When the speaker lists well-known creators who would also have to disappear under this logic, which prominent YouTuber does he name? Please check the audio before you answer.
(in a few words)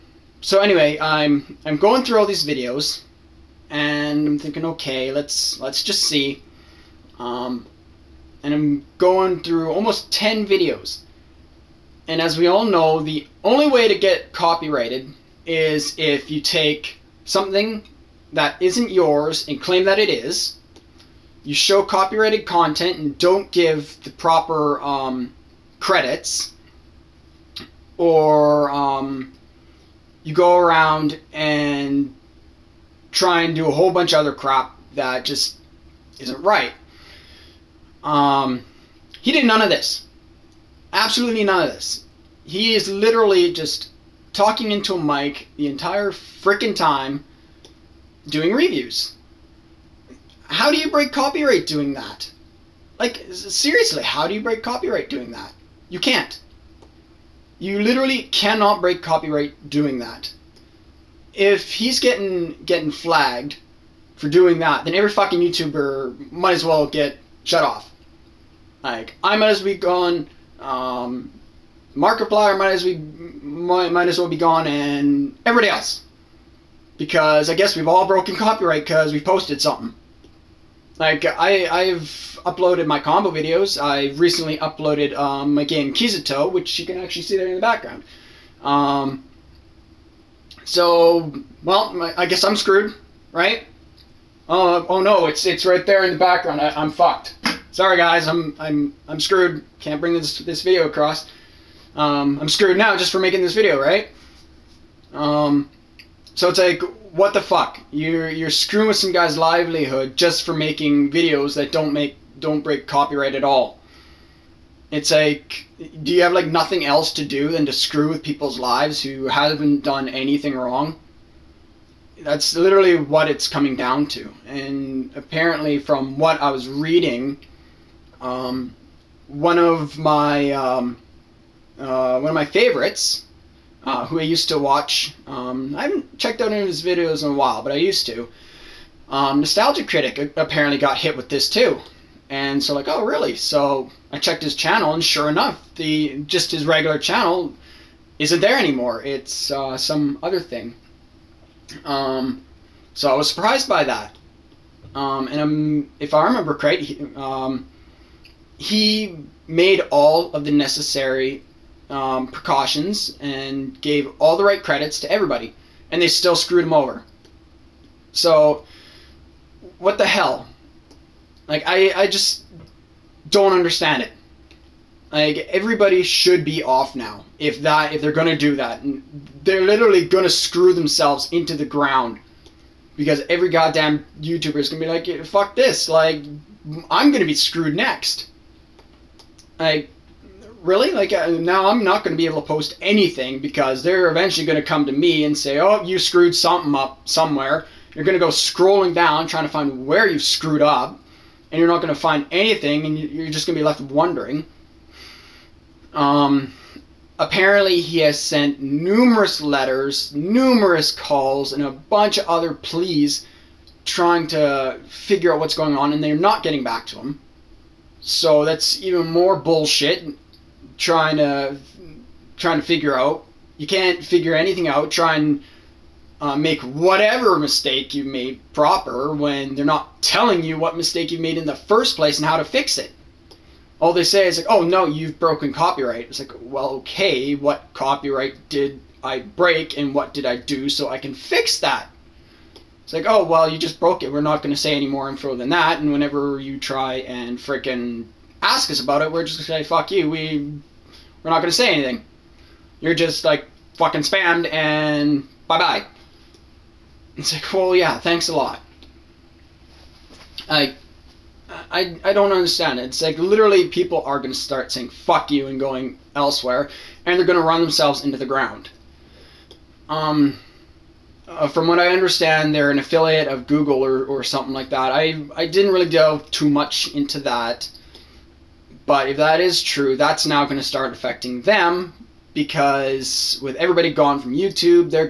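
Markiplier.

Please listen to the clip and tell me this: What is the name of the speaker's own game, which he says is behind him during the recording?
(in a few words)
Kizuto.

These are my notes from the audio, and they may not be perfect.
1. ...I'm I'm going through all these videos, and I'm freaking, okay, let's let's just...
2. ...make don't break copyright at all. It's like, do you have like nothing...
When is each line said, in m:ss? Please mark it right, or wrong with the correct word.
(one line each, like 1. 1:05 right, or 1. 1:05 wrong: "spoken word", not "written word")
1. 0:00 wrong: "thinking", not "freaking"
2. 1:51 right.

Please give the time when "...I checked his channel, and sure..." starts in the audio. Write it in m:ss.
2:24.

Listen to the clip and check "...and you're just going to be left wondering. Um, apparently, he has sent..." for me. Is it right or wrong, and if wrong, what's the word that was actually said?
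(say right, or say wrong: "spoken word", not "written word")
right.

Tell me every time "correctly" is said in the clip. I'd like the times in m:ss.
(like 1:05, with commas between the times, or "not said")
2:36.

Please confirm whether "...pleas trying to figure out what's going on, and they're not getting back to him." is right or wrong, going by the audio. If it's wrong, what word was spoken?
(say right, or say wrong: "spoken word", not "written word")
right.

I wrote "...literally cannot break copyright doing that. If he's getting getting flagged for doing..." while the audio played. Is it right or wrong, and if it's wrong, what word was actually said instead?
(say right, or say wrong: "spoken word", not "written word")
right.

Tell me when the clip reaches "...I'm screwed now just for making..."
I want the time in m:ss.
1:42.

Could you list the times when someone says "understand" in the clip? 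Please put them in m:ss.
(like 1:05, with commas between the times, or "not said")
2:53, 4:22, 4:31.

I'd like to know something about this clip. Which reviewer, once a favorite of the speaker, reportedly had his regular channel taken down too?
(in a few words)
Nostalgia Critic.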